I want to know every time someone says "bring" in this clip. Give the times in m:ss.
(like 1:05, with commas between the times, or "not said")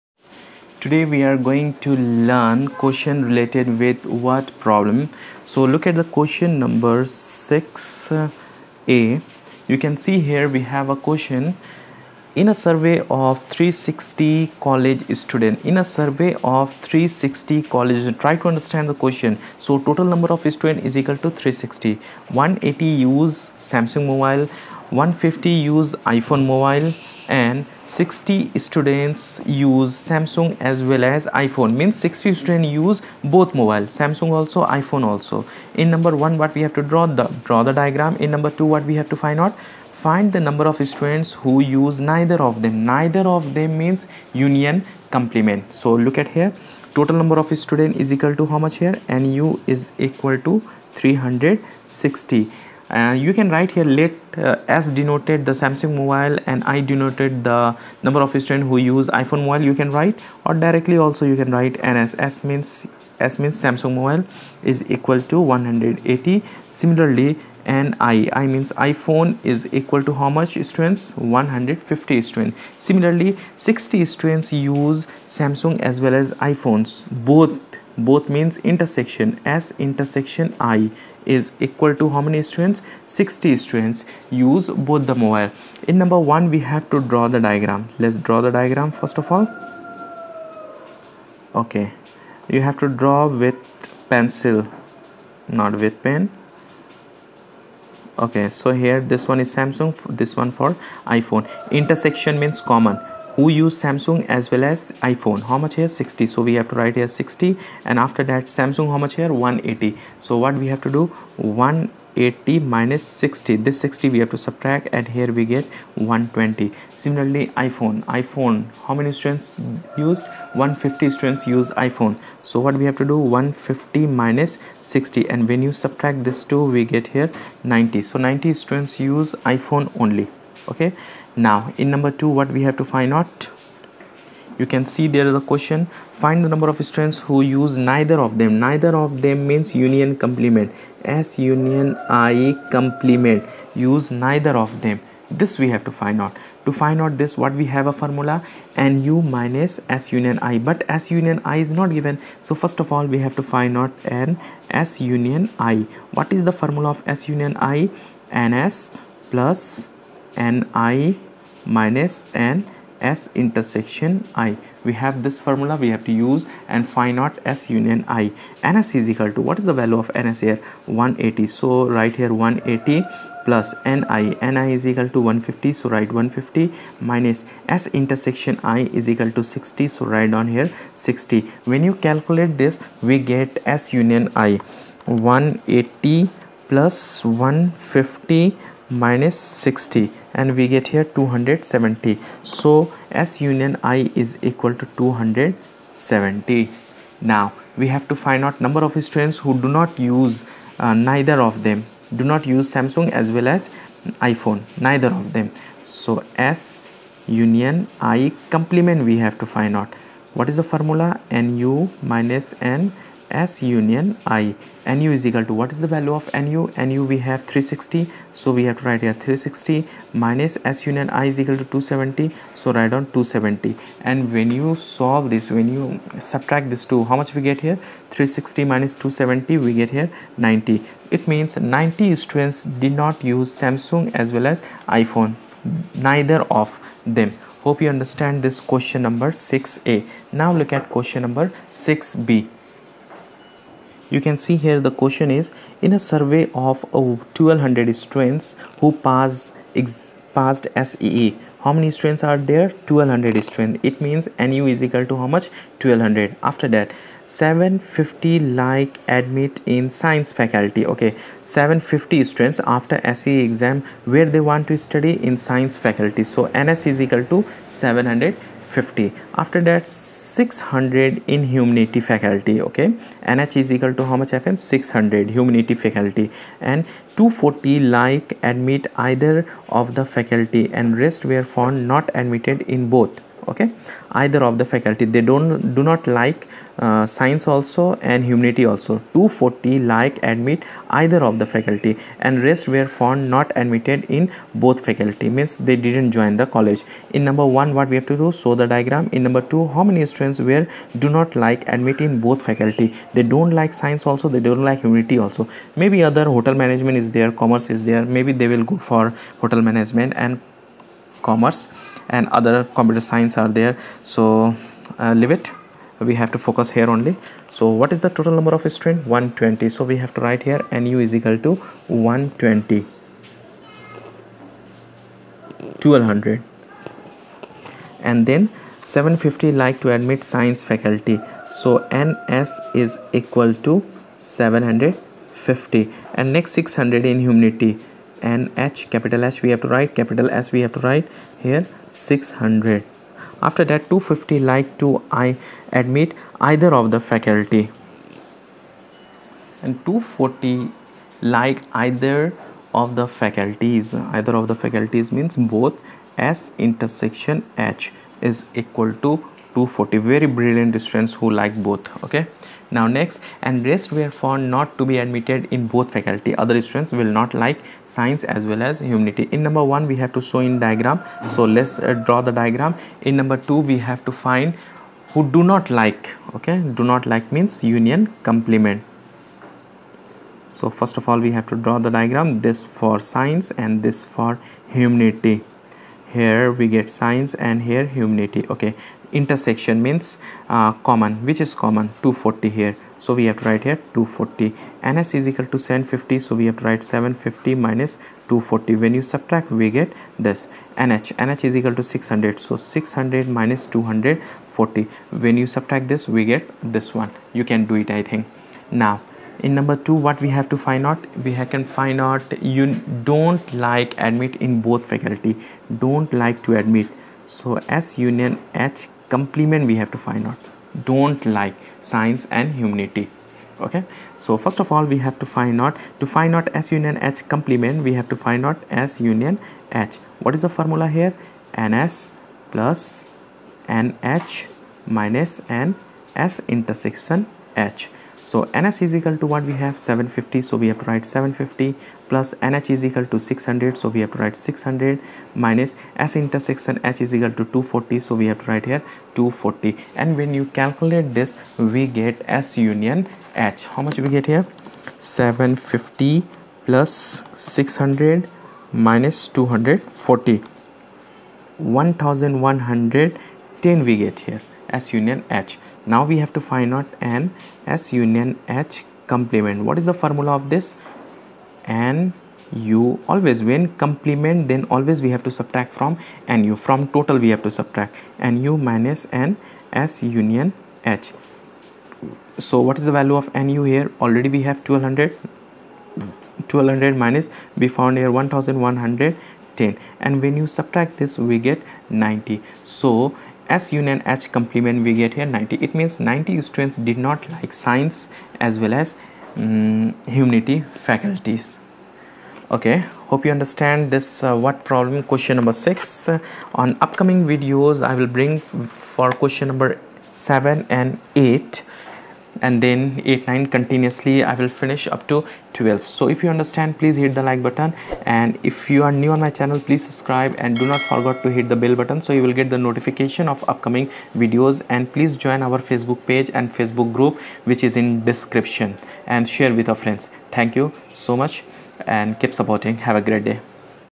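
8:28.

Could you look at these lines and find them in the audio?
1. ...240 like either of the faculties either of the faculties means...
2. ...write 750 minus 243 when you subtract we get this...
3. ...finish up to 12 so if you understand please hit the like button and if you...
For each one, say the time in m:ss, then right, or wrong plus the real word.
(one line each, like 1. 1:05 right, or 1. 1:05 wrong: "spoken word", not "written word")
1. 5:49 right
2. 6:36 wrong: "240", not "243"
3. 8:34 right.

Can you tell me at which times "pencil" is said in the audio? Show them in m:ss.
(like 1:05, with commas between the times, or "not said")
1:34.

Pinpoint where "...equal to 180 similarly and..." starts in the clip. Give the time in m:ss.
1:04.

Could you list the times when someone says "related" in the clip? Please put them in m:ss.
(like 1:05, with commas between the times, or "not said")
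0:03.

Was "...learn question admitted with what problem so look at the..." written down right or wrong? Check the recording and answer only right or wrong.
wrong.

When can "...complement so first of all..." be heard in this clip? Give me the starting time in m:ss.
6:18.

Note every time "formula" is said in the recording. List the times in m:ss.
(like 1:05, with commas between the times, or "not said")
2:27, 2:36, 2:45, 3:30, 7:10, 7:49.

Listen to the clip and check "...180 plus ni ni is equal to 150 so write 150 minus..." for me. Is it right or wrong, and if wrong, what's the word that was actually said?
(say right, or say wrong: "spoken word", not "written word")
right.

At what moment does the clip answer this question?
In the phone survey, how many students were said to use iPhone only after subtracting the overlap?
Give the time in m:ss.
2:08.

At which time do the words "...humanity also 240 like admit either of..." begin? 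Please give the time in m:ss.
4:48.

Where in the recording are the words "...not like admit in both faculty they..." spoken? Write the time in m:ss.
5:01.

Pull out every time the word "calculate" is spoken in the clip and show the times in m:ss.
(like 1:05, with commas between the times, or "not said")
3:02, 7:30.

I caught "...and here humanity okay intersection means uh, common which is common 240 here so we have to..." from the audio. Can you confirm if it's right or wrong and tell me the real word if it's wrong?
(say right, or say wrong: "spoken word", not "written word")
right.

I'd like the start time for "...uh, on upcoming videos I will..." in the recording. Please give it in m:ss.
8:25.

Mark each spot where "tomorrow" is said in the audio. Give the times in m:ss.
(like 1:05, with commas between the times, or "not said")
not said.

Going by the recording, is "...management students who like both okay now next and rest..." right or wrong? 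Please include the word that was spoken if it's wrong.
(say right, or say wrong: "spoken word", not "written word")
wrong: "brilliant", not "management".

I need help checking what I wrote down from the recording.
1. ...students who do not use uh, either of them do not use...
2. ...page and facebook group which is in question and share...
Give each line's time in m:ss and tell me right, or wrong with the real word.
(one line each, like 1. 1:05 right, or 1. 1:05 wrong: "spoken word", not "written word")
1. 3:19 wrong: "neither", not "either"
2. 8:46 wrong: "description", not "question".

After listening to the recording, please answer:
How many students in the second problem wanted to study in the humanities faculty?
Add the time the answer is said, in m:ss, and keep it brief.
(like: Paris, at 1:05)
600, at 4:34.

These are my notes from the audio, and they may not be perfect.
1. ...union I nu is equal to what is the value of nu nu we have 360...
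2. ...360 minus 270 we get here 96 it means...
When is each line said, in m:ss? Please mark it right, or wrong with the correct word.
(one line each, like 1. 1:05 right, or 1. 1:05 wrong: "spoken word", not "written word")
1. 3:33 right
2. 3:48 wrong: "90", not "96".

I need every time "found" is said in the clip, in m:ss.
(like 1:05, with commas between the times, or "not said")
4:41, 4:52, 6:04, 8:07.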